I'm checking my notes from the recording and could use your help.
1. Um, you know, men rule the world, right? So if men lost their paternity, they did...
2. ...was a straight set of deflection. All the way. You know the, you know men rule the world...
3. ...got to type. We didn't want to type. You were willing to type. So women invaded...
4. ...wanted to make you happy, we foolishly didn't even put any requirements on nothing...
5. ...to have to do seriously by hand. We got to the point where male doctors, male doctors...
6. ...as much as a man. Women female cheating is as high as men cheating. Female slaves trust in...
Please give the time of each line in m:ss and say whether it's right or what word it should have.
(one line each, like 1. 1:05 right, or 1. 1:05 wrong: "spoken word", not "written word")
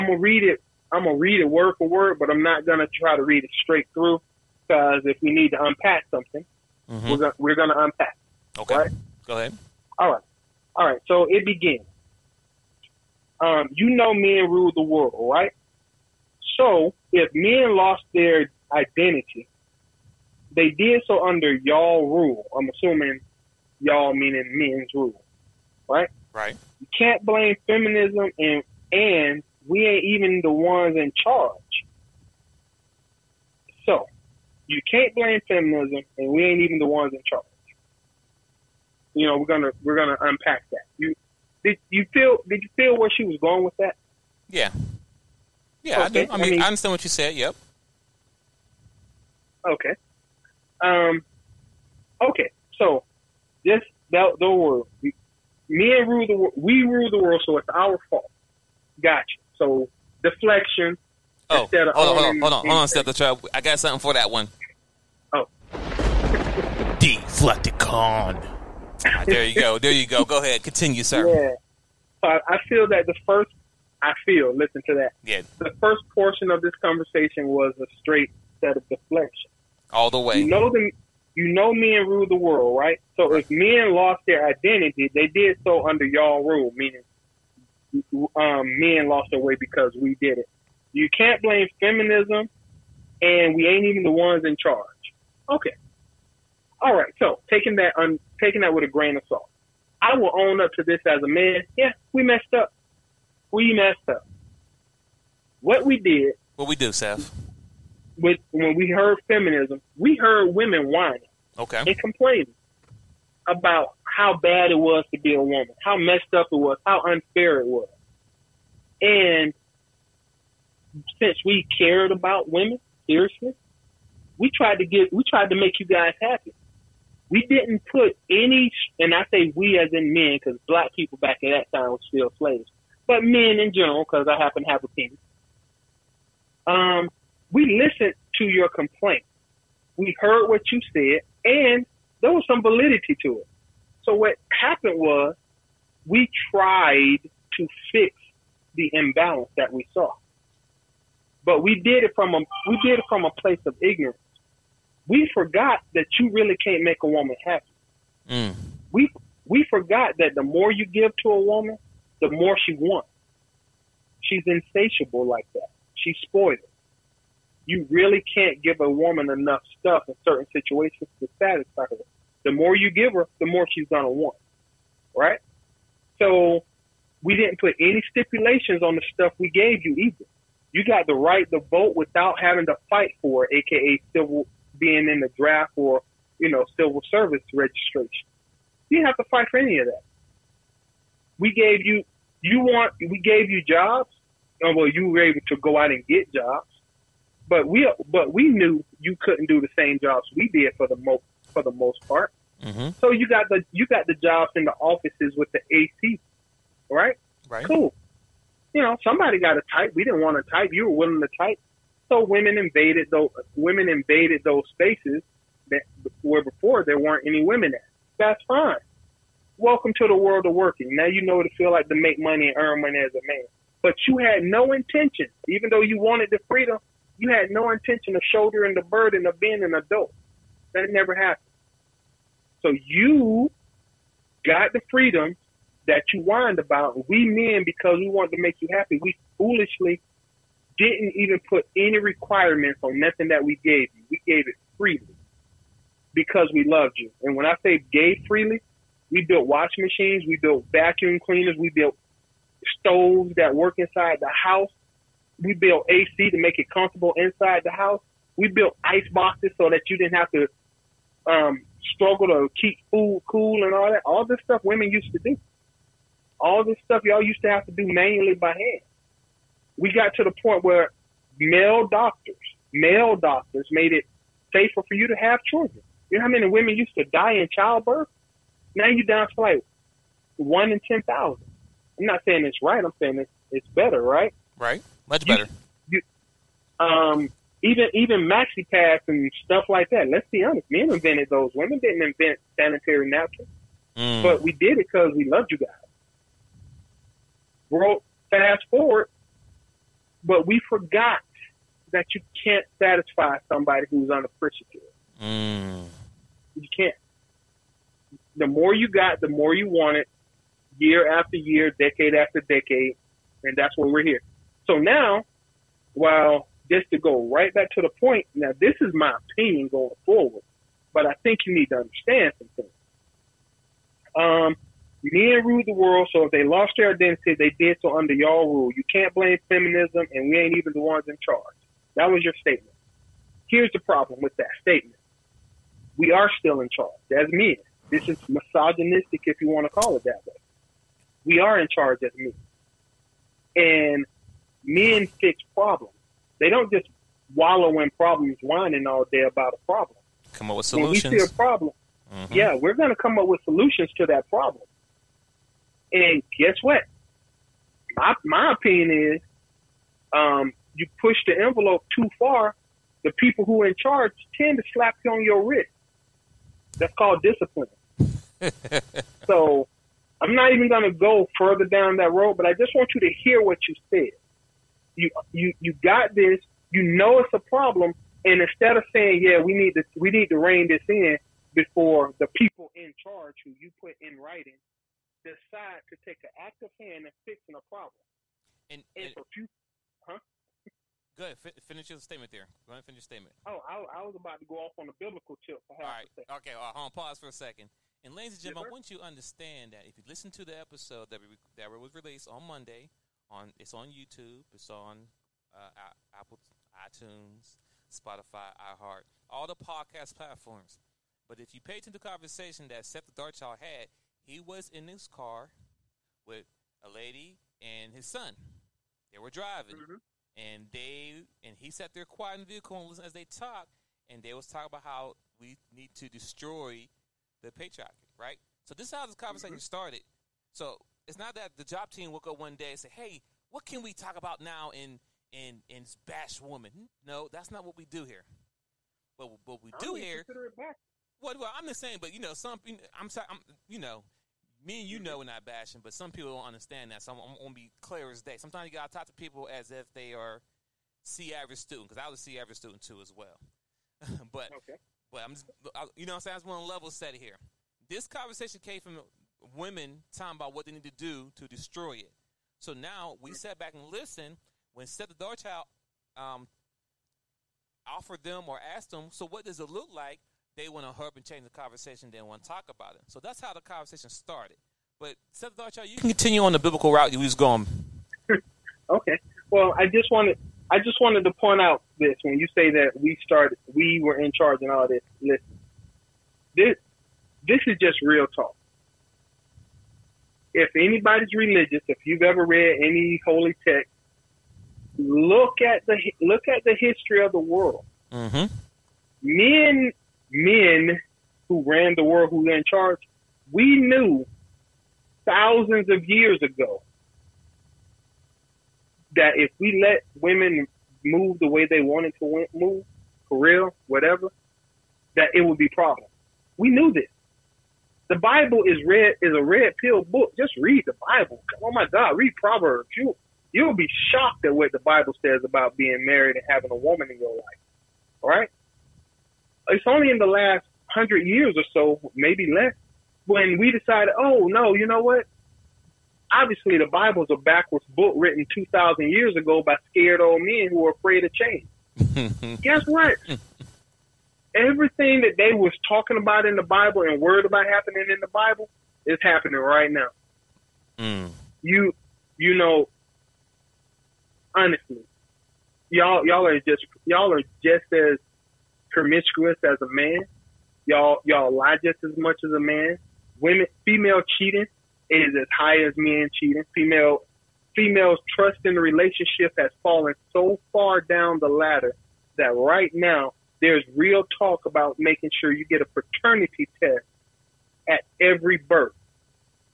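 1. 0:13 wrong: "identity", not "paternity"
2. 1:17 right
3. 3:29 right
4. 3:58 right
5. 4:27 wrong: "manually", not "seriously"
6. 9:22 wrong: "females", not "slaves".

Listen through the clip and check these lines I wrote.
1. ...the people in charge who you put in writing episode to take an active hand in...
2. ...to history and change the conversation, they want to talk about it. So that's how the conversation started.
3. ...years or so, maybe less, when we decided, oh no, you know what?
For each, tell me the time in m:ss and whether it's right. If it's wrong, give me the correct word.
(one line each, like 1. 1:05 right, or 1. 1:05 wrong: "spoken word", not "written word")
1. 6:22 wrong: "decide", not "episode"
2. 7:50 wrong: "hurry", not "history"
3. 8:51 right.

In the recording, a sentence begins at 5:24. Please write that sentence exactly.
Um, Men rule the world, so if they lost their identity, they did so under y'all rule.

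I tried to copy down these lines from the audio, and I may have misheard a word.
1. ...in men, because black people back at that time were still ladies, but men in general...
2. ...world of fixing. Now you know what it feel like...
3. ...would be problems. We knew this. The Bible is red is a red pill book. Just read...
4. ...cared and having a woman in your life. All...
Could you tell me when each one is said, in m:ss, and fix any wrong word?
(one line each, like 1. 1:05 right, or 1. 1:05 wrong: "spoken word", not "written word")
1. 2:09 wrong: "slaves", not "ladies"
2. 3:40 wrong: "working", not "fixing"
3. 8:35 right
4. 8:46 wrong: "married", not "cared".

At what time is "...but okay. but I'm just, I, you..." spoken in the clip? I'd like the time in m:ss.
7:34.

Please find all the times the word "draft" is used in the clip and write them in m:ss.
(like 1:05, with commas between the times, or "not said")
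3:05.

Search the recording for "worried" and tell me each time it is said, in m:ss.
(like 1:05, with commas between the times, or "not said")
9:07.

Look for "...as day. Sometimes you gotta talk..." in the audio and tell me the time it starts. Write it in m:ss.
7:28.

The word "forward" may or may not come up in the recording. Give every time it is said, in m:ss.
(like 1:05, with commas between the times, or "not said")
4:58, 5:20.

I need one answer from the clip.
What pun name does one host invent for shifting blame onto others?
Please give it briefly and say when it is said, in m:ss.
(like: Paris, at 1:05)
Deflecticon, at 1:06.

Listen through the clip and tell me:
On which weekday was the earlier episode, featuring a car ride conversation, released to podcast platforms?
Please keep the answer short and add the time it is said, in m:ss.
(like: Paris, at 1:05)
Monday, at 6:42.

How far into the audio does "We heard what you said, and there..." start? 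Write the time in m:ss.
2:19.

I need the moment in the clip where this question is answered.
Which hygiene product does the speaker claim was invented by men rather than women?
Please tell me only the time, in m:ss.
4:52.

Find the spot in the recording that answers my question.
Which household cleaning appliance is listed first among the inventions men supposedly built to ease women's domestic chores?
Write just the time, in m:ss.
4:09.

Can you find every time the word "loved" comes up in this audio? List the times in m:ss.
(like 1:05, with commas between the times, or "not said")
4:06, 4:55.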